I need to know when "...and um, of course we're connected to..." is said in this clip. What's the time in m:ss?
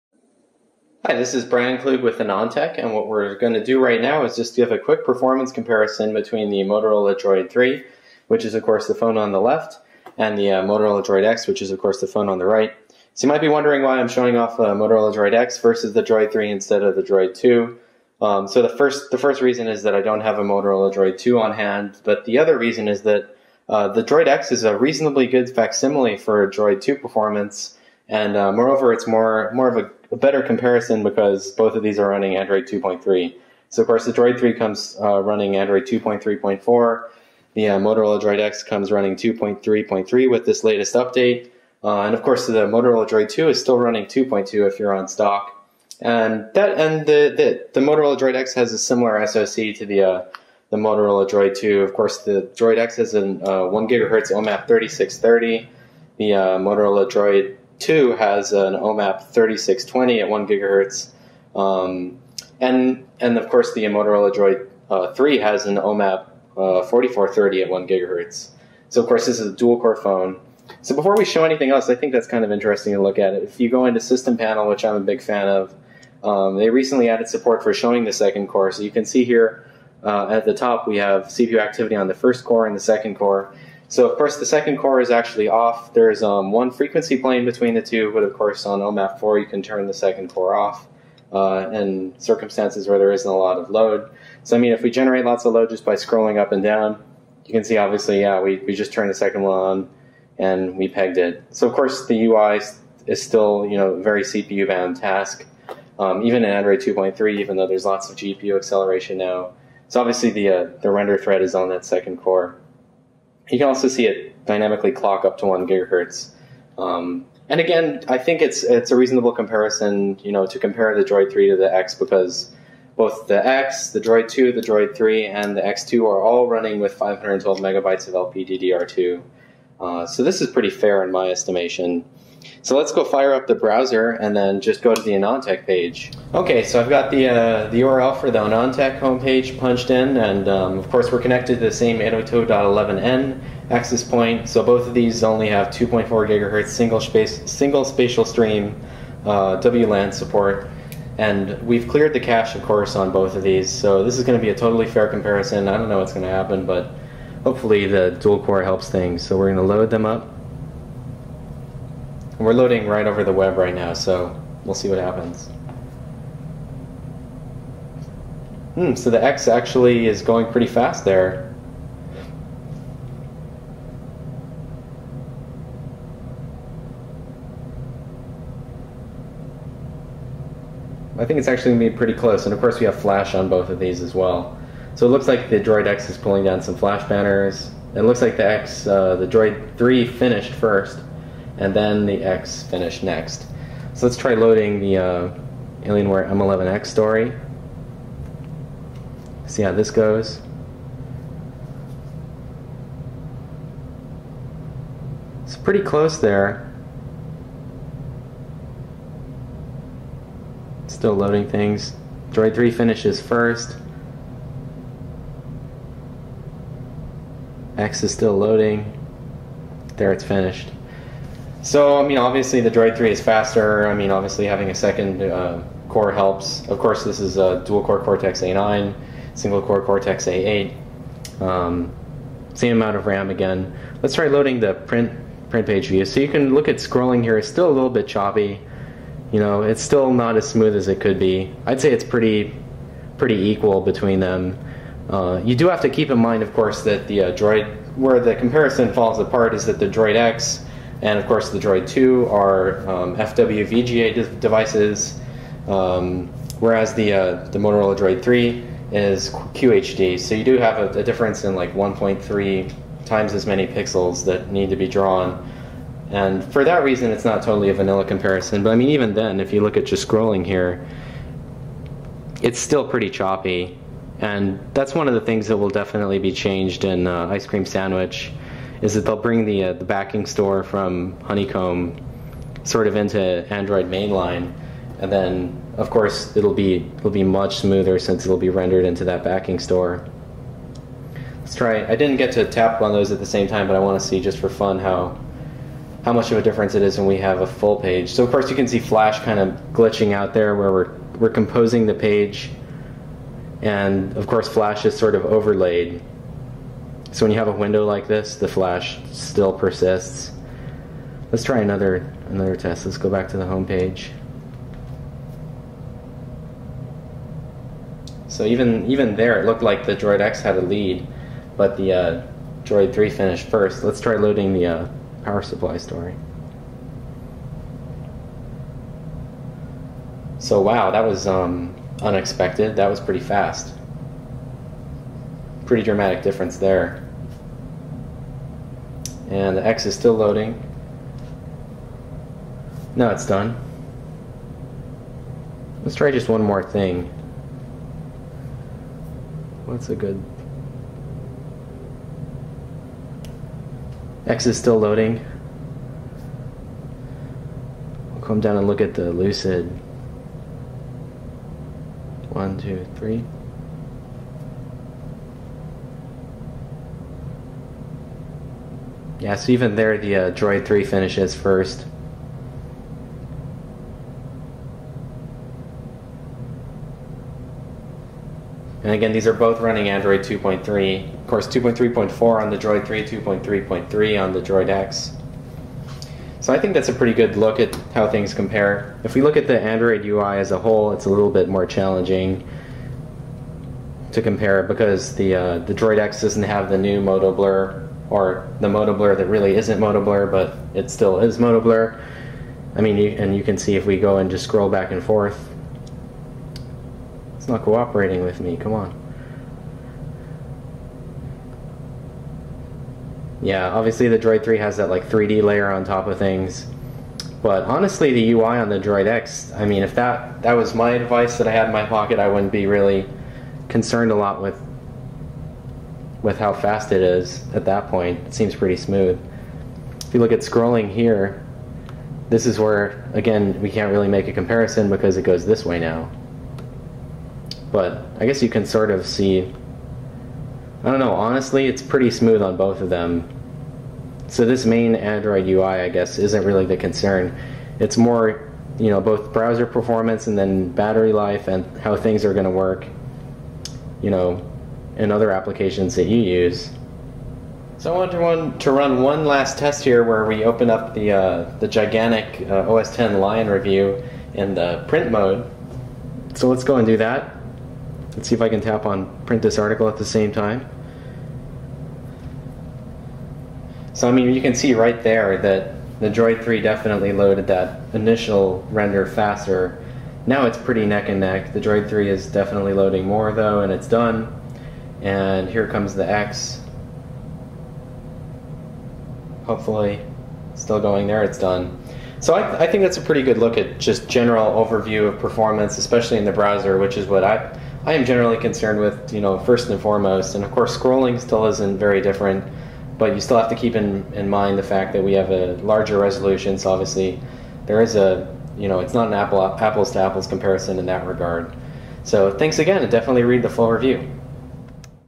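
2:20.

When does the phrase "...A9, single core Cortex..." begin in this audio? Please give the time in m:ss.
3:48.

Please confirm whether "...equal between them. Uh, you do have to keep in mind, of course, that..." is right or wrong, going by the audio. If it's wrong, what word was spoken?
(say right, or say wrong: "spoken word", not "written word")
right.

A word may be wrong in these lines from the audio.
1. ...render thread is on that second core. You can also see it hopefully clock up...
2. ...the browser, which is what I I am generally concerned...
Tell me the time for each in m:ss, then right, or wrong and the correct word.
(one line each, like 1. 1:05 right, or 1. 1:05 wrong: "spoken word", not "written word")
1. 1:50 wrong: "dynamically", not "hopefully"
2. 8:16 right.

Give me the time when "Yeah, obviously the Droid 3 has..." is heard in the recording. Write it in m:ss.
6:53.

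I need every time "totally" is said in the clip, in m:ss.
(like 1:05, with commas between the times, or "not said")
2:34, 4:27.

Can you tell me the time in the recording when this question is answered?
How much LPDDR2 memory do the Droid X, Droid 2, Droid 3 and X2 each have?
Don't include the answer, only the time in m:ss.
2:06.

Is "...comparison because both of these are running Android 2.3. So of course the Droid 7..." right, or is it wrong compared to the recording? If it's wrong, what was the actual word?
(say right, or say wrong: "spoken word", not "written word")
wrong: "3", not "7".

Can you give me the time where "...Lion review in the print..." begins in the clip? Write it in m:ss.
7:43.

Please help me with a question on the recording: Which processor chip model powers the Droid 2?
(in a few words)
OMAP 3620.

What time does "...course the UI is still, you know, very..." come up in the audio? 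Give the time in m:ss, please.
1:41.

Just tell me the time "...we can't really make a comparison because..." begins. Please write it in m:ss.
7:13.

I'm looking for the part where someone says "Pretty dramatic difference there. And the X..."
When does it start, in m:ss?
5:35.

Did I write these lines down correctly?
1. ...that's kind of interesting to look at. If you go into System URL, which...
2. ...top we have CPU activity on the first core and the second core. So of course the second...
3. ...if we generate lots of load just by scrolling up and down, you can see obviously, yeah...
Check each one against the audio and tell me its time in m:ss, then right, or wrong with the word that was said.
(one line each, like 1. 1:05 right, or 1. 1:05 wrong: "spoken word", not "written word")
1. 1:12 wrong: "Panel", not "URL"
2. 1:20 right
3. 1:34 right.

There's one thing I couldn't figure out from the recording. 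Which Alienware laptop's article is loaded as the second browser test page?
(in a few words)
M11X.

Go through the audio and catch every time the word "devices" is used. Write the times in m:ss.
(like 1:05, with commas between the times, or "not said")
4:14, 7:00.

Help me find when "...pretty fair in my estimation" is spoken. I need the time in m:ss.
2:10.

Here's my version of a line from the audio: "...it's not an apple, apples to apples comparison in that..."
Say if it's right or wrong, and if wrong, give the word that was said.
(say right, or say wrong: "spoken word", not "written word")
right.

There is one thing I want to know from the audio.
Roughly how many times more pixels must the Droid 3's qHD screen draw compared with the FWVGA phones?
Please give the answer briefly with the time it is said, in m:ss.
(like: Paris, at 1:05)
1.3 times, at 4:21.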